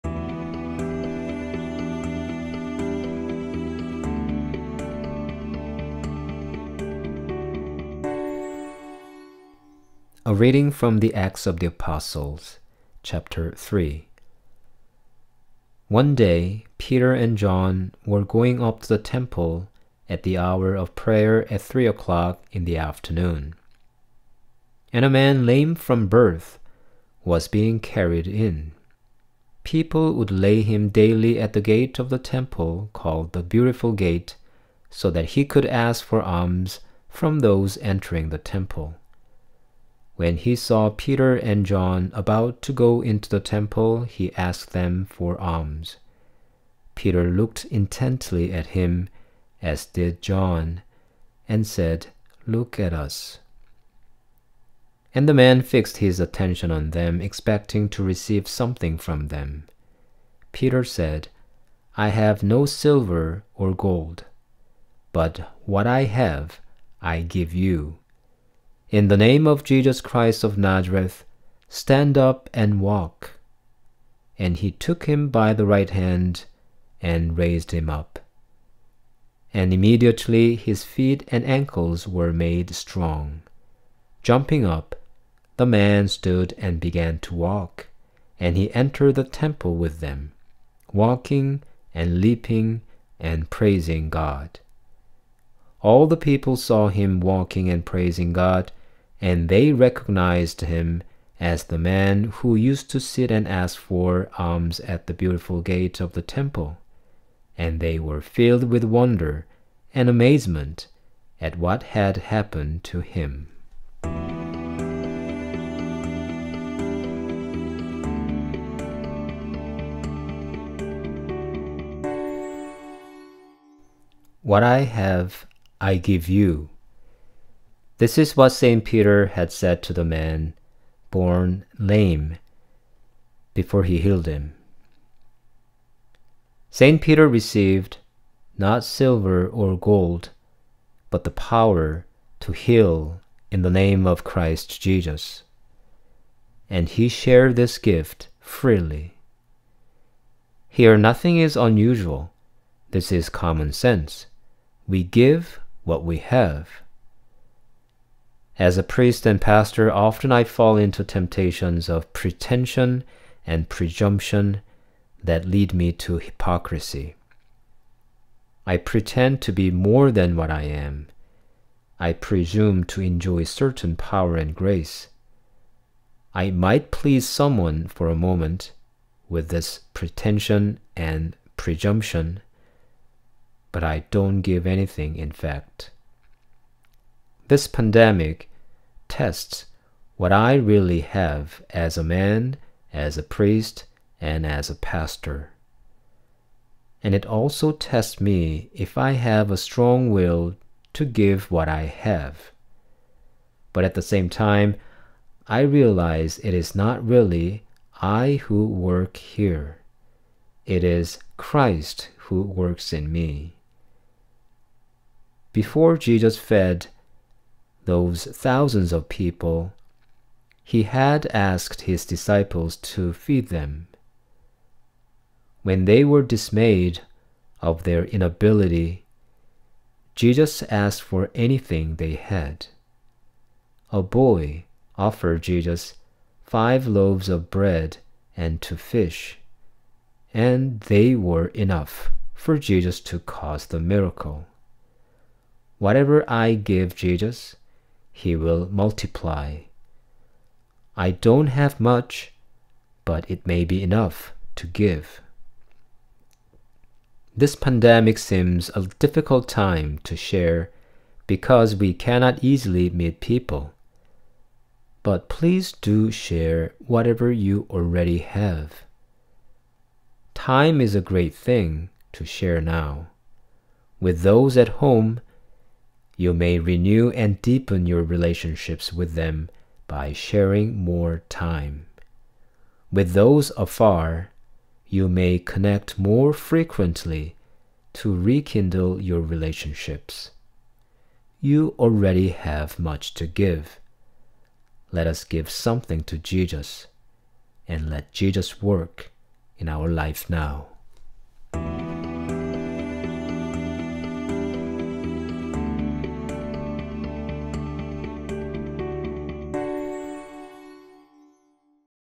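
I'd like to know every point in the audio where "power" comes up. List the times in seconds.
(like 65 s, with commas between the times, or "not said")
141 s, 173 s.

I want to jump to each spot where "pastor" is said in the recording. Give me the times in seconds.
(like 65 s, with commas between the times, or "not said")
159 s, 194 s.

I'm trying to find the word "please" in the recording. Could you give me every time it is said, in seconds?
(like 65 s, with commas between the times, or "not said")
176 s, 265 s.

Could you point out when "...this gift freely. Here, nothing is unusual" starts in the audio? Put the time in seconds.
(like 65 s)
147 s.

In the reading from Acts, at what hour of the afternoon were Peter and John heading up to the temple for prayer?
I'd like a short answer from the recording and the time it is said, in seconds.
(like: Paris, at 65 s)
3 o'clock, at 21 s.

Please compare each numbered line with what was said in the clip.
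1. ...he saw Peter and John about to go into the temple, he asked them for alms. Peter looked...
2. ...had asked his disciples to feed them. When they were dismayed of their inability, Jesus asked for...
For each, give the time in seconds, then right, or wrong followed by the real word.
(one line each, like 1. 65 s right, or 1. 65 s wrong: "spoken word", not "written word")
1. 40 s right
2. 220 s right.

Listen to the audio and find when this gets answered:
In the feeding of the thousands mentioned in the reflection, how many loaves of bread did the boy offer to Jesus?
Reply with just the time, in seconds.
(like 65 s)
236 s.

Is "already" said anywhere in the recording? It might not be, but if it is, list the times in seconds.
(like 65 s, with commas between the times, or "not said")
267 s, 291 s.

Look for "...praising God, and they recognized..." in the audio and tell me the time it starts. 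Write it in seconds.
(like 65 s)
97 s.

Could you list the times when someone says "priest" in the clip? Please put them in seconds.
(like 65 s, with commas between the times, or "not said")
158 s, 193 s.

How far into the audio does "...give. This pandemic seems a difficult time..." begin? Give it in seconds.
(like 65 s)
254 s.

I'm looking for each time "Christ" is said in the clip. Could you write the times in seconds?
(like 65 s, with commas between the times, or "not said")
70 s, 144 s, 211 s.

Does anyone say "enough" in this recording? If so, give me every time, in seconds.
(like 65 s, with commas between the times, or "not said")
241 s, 253 s.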